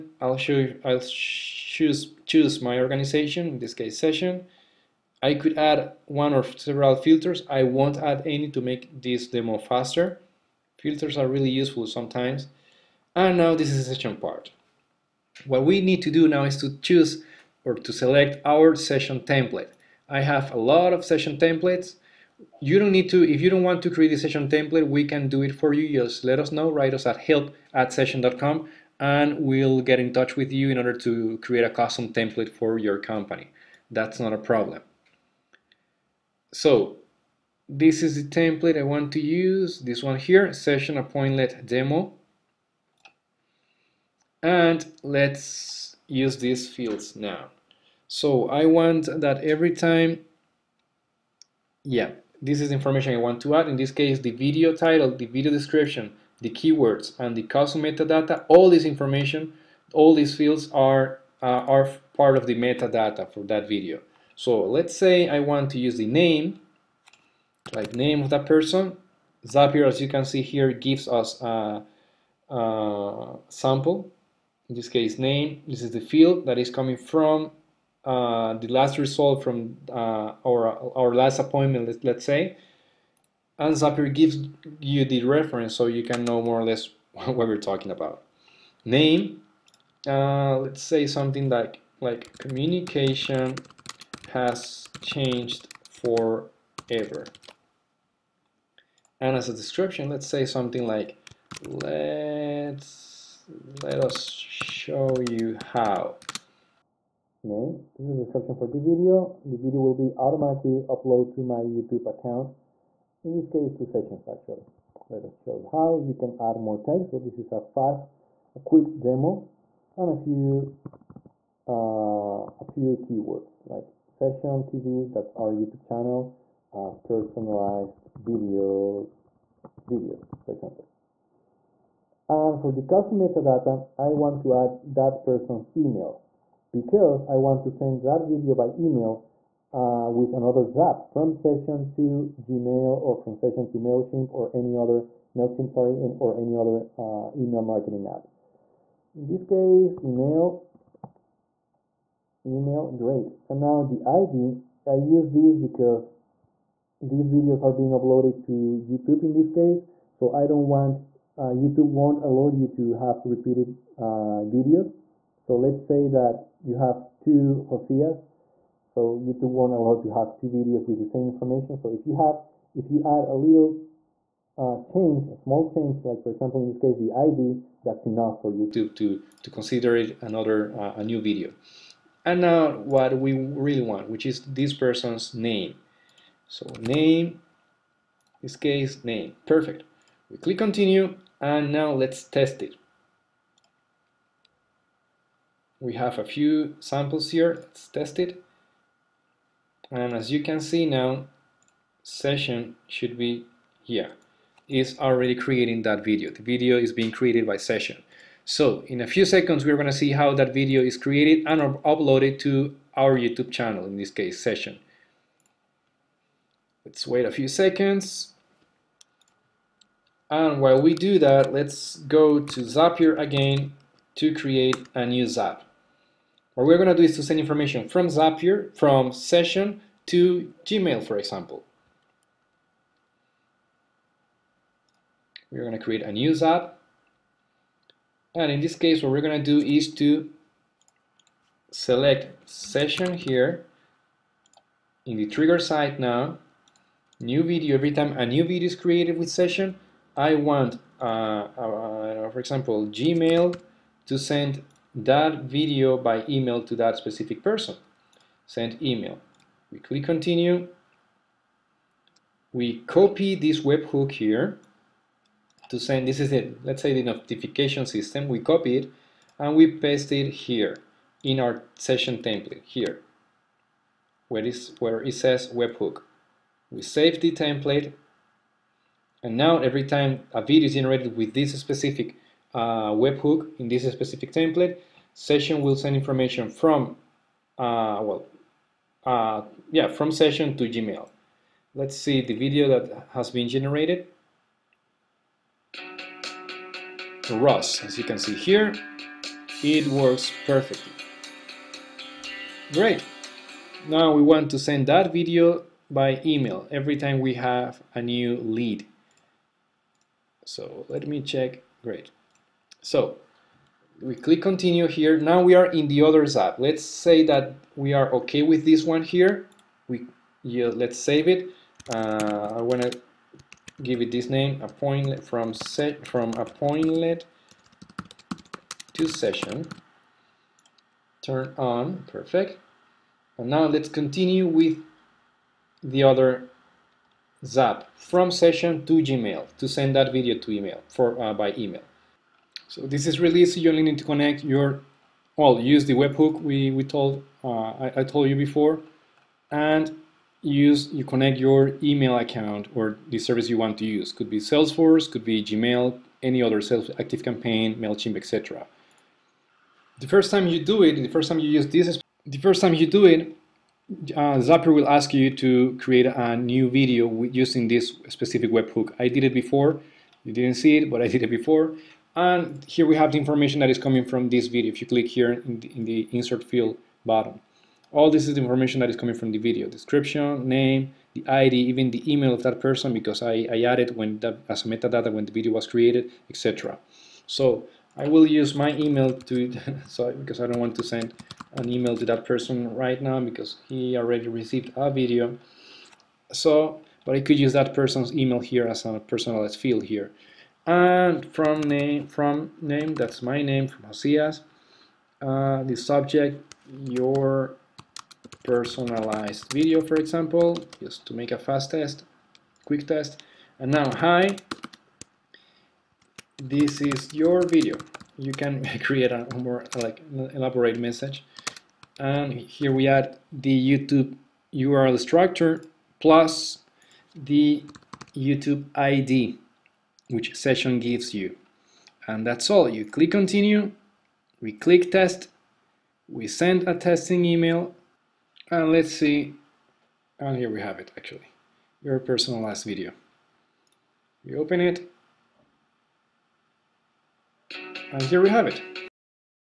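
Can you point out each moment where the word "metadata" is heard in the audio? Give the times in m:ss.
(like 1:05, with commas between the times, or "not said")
0:57, 1:02, 2:13, 6:24.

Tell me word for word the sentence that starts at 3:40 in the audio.
And while we do that, let's go to Zapier again to create a new Zap.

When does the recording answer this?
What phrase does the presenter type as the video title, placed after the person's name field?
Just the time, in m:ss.
1:32.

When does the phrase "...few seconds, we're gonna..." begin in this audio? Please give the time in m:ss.
3:29.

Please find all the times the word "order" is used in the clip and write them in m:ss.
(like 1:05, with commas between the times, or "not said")
0:30.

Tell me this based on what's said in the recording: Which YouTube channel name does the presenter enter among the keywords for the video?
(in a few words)
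Sezion TV.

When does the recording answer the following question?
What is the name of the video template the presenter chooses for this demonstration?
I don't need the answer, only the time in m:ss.
0:40.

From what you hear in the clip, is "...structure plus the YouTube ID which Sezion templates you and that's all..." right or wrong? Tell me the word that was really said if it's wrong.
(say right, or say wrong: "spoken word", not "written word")
wrong: "gives", not "templates".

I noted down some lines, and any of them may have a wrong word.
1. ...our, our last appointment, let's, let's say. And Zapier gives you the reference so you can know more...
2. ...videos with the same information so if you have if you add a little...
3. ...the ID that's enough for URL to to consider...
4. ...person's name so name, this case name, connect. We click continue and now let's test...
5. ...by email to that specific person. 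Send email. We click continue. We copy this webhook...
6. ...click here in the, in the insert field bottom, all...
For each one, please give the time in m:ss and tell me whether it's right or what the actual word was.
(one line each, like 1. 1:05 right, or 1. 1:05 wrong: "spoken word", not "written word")
1. 1:20 right
2. 2:50 right
3. 2:56 wrong: "YouTube", not "URL"
4. 3:04 wrong: "perfect", not "connect"
5. 4:15 right
6. 6:14 right.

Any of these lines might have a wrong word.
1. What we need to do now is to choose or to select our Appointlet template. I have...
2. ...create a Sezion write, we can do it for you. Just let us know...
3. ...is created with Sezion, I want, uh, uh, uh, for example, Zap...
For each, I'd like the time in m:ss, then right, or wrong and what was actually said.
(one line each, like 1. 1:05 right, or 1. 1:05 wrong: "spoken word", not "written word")
1. 0:15 wrong: "Sezion", not "Appointlet"
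2. 0:23 wrong: "template", not "write"
3. 4:08 wrong: "Gmail", not "Zap".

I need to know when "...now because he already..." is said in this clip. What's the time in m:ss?
6:33.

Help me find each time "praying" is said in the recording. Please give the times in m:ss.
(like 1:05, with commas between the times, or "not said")
not said.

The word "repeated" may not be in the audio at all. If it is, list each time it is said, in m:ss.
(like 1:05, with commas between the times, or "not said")
2:43.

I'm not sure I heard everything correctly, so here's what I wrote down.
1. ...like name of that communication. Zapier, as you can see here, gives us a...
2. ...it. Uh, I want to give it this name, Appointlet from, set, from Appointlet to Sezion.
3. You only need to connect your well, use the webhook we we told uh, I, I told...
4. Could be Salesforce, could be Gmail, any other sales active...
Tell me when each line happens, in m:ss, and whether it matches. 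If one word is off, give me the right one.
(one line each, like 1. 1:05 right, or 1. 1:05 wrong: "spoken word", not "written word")
1. 1:07 wrong: "person", not "communication"
2. 5:21 right
3. 5:43 right
4. 5:54 right.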